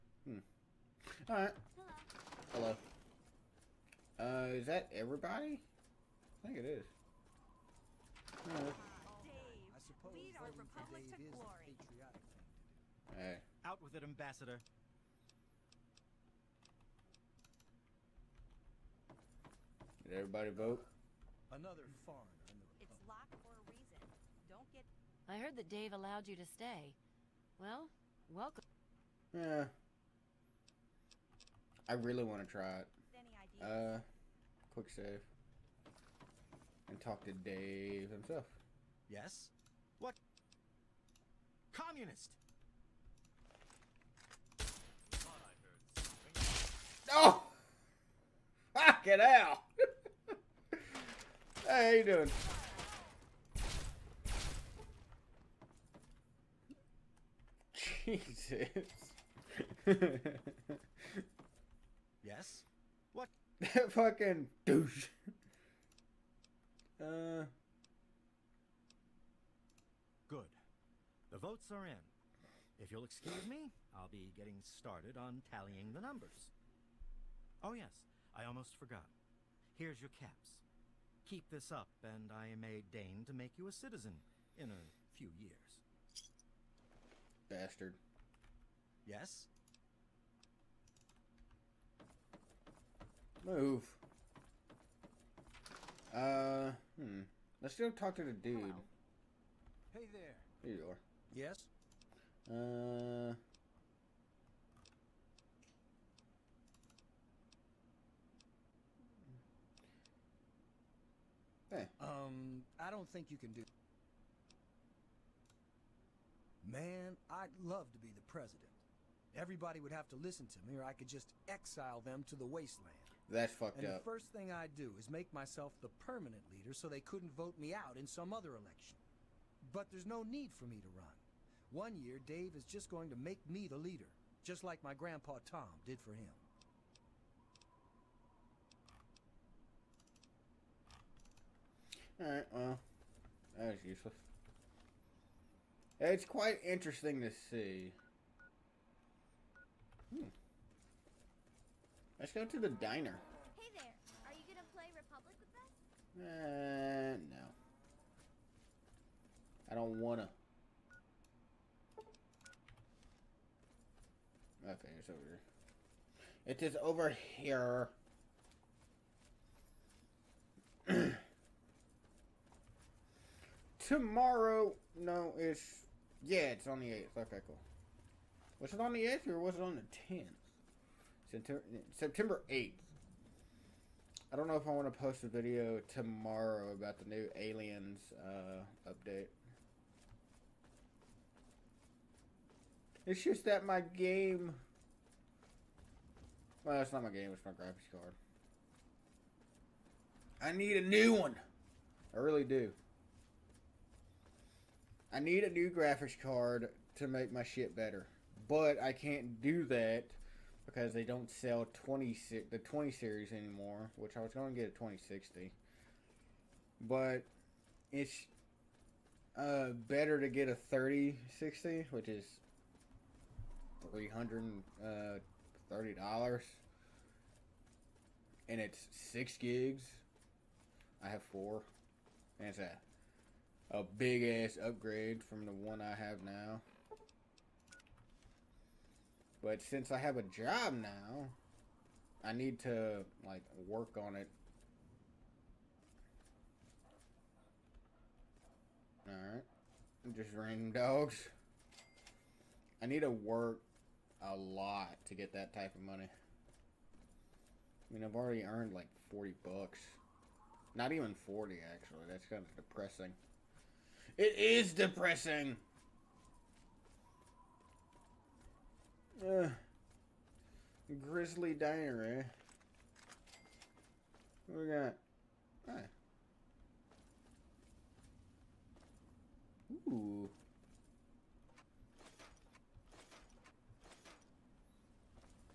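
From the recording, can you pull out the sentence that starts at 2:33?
Hey there, are you gonna play Republic with us?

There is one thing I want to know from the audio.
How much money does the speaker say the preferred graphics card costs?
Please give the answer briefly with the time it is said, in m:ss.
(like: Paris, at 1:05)
$330, at 3:43.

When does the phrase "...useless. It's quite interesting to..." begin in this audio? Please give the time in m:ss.
2:23.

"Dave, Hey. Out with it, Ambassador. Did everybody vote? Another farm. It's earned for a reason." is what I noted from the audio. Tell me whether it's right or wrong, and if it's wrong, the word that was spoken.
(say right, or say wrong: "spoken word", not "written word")
wrong: "locked", not "earned".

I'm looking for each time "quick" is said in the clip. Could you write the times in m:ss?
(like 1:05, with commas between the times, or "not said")
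0:34.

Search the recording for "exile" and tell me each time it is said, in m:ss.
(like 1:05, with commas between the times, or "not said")
2:01.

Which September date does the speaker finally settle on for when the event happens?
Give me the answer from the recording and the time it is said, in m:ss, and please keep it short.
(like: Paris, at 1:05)
September 8, at 3:01.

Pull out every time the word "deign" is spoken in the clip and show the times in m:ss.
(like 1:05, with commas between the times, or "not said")
1:22.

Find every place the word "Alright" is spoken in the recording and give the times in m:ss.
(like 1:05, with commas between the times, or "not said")
0:01, 2:22.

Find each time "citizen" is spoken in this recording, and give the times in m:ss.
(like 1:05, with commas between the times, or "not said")
1:23.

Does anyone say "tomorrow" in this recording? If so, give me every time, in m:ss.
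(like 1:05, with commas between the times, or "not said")
2:53, 3:05.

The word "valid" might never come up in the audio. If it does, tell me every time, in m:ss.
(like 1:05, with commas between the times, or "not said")
not said.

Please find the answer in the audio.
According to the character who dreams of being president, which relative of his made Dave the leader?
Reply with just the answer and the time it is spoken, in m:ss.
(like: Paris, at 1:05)
Grandpa Tom, at 2:14.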